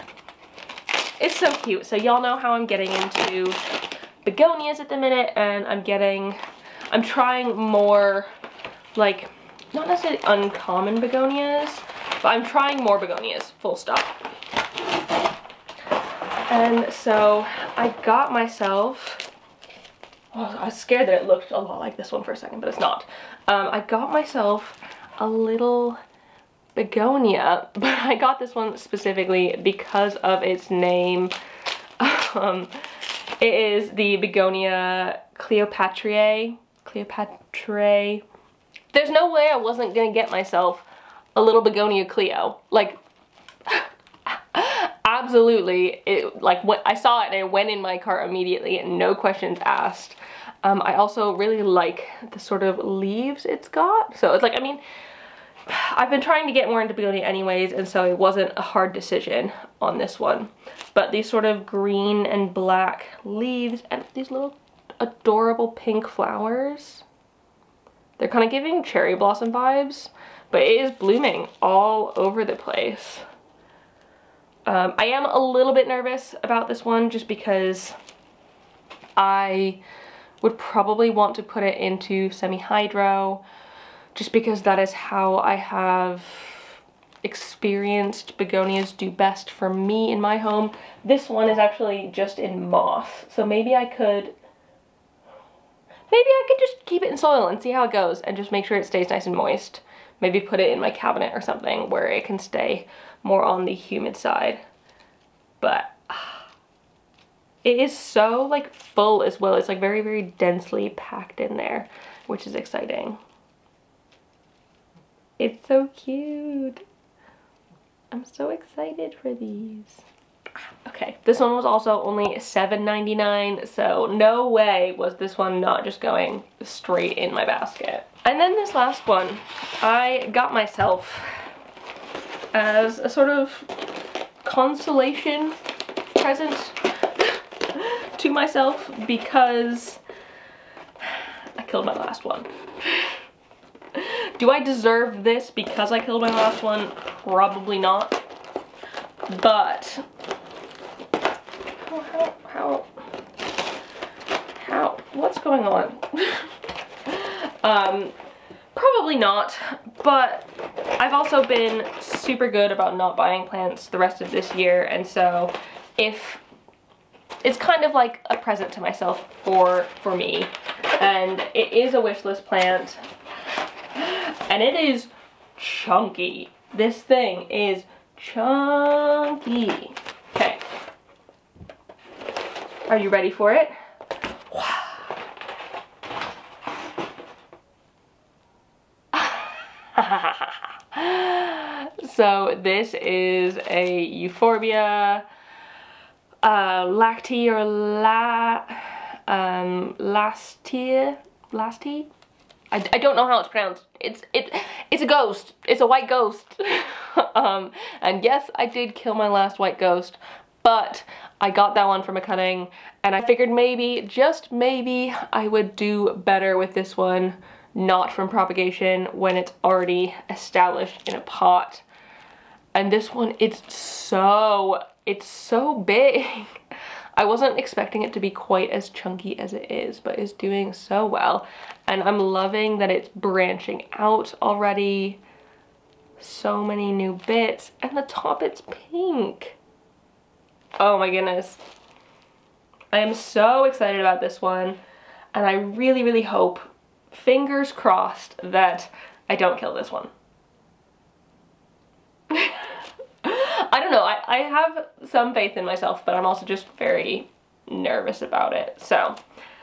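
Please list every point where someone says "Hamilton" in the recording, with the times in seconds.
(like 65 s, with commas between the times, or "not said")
not said.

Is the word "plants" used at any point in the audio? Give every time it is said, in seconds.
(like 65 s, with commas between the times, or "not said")
163 s, 172 s.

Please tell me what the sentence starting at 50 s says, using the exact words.
Um, I also really like the sort of leaves it's got.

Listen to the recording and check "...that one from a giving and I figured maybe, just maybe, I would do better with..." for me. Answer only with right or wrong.
wrong.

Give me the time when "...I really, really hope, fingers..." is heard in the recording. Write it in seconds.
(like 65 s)
245 s.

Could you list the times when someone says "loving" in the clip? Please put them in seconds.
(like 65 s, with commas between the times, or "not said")
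232 s.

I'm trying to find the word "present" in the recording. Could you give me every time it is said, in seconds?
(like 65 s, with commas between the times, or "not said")
136 s, 168 s.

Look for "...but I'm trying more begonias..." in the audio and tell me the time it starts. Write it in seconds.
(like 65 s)
12 s.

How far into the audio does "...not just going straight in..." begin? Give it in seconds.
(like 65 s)
125 s.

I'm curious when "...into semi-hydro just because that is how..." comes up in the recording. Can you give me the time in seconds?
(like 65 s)
81 s.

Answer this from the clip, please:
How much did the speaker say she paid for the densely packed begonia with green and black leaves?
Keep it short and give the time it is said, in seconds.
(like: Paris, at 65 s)
$7.99, at 122 s.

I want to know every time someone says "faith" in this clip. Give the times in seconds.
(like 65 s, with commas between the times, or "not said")
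255 s.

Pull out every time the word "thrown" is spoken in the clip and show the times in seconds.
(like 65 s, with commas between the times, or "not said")
not said.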